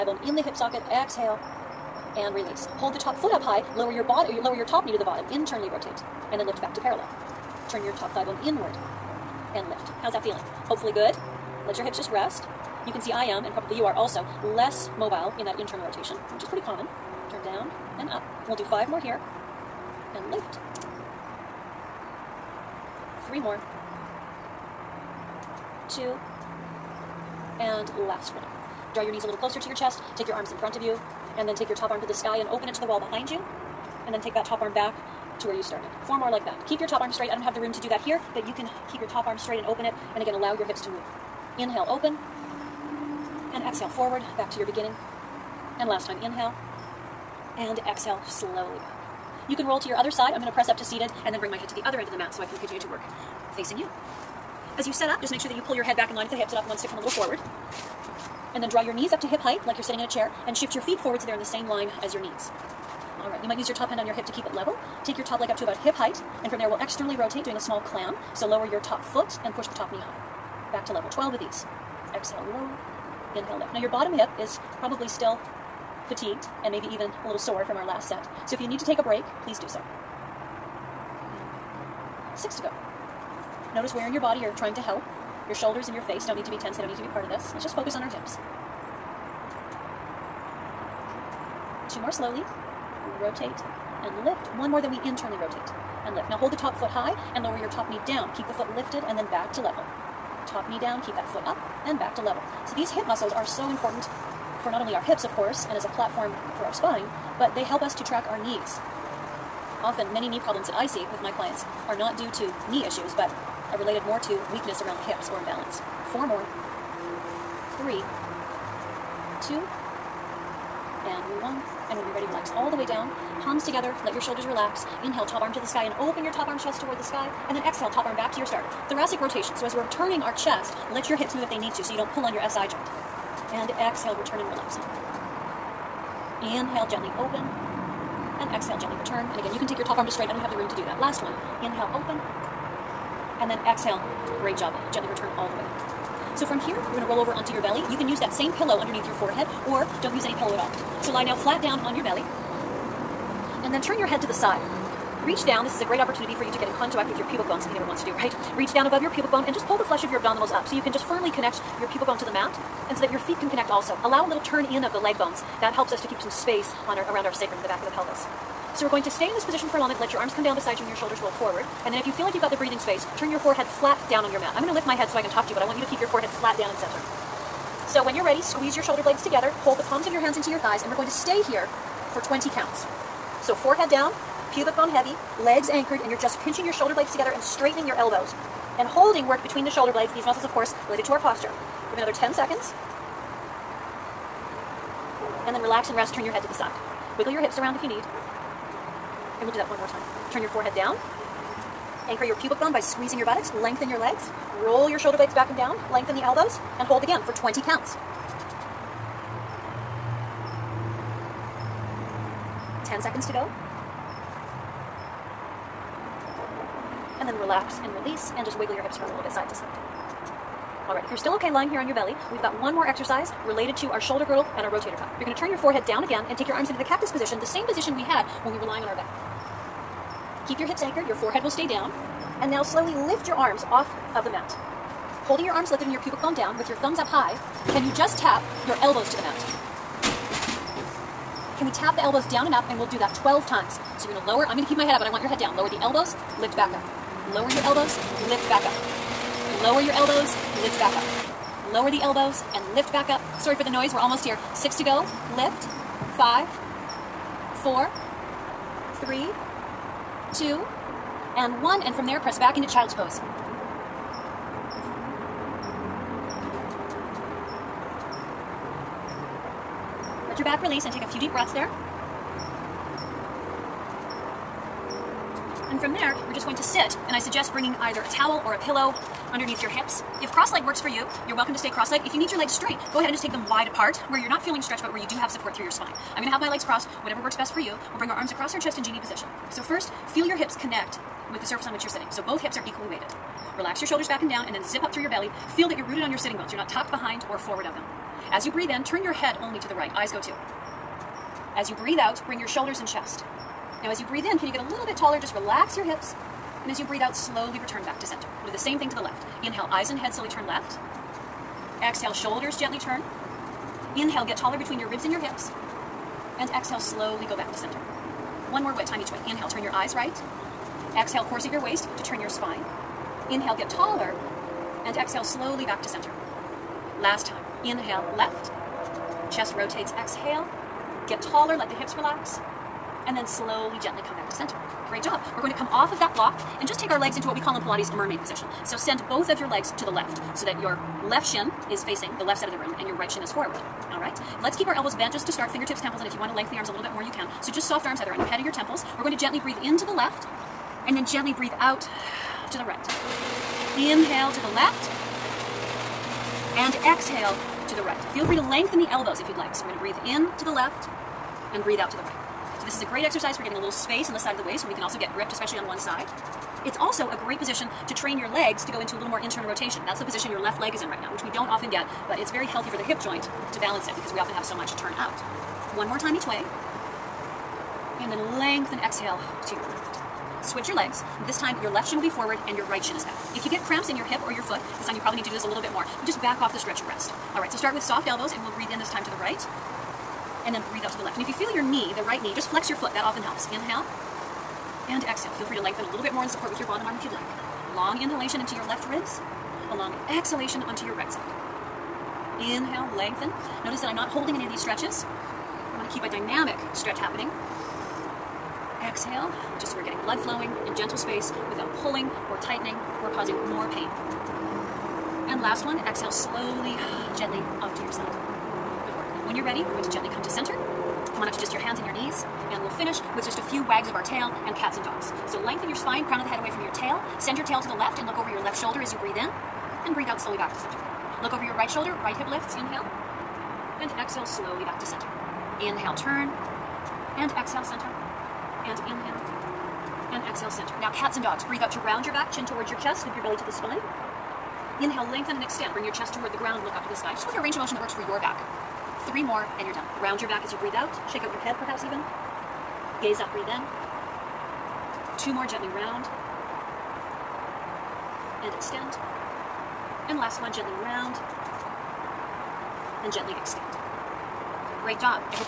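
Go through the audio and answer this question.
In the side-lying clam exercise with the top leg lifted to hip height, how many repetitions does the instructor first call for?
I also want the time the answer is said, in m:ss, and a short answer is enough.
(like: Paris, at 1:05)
12, at 1:11.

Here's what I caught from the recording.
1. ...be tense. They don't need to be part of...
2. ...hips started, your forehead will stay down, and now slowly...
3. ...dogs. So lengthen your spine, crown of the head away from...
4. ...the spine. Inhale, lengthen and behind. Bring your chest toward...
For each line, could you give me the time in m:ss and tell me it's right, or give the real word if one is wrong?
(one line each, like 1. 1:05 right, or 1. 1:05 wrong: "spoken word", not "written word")
1. 1:26 right
2. 3:50 wrong: "anchored", not "started"
3. 7:04 right
4. 7:23 wrong: "extend", not "behind".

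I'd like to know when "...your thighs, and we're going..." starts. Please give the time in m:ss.
3:00.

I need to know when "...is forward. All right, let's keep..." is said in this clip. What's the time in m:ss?
5:43.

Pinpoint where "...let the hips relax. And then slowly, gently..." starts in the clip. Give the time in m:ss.
5:31.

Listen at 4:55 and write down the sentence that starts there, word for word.
Feel that you're rooted on your sitting bones.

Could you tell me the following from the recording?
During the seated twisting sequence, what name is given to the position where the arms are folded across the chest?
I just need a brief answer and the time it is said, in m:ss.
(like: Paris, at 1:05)
genie position, at 4:48.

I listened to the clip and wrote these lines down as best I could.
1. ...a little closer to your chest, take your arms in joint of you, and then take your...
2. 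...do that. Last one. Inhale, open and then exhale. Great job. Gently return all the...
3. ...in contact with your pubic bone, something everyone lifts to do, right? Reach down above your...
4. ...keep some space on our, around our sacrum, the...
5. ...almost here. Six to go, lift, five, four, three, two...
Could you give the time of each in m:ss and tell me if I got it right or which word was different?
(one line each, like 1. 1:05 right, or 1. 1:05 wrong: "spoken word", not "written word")
1. 0:29 wrong: "front", not "joint"
2. 2:20 right
3. 2:36 wrong: "wants", not "lifts"
4. 2:46 right
5. 4:13 right.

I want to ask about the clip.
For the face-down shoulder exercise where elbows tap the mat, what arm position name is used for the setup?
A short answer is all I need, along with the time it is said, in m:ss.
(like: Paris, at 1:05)
cactus position, at 3:46.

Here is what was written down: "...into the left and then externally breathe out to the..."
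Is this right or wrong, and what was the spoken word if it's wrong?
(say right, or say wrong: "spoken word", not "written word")
wrong: "gently", not "externally".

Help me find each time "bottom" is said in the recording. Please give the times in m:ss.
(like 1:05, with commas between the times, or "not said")
0:05, 1:13, 6:36.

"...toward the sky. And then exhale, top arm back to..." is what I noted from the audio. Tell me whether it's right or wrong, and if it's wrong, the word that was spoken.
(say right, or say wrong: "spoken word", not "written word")
right.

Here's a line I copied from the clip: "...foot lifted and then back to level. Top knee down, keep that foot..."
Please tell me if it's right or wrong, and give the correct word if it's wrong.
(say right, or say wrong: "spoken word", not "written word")
right.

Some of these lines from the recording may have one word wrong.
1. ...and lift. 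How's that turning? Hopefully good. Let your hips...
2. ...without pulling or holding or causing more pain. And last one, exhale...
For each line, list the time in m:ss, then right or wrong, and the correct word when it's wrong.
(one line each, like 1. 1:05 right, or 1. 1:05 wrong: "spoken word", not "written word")
1. 0:09 wrong: "feeling", not "turning"
2. 6:51 wrong: "tightening", not "holding".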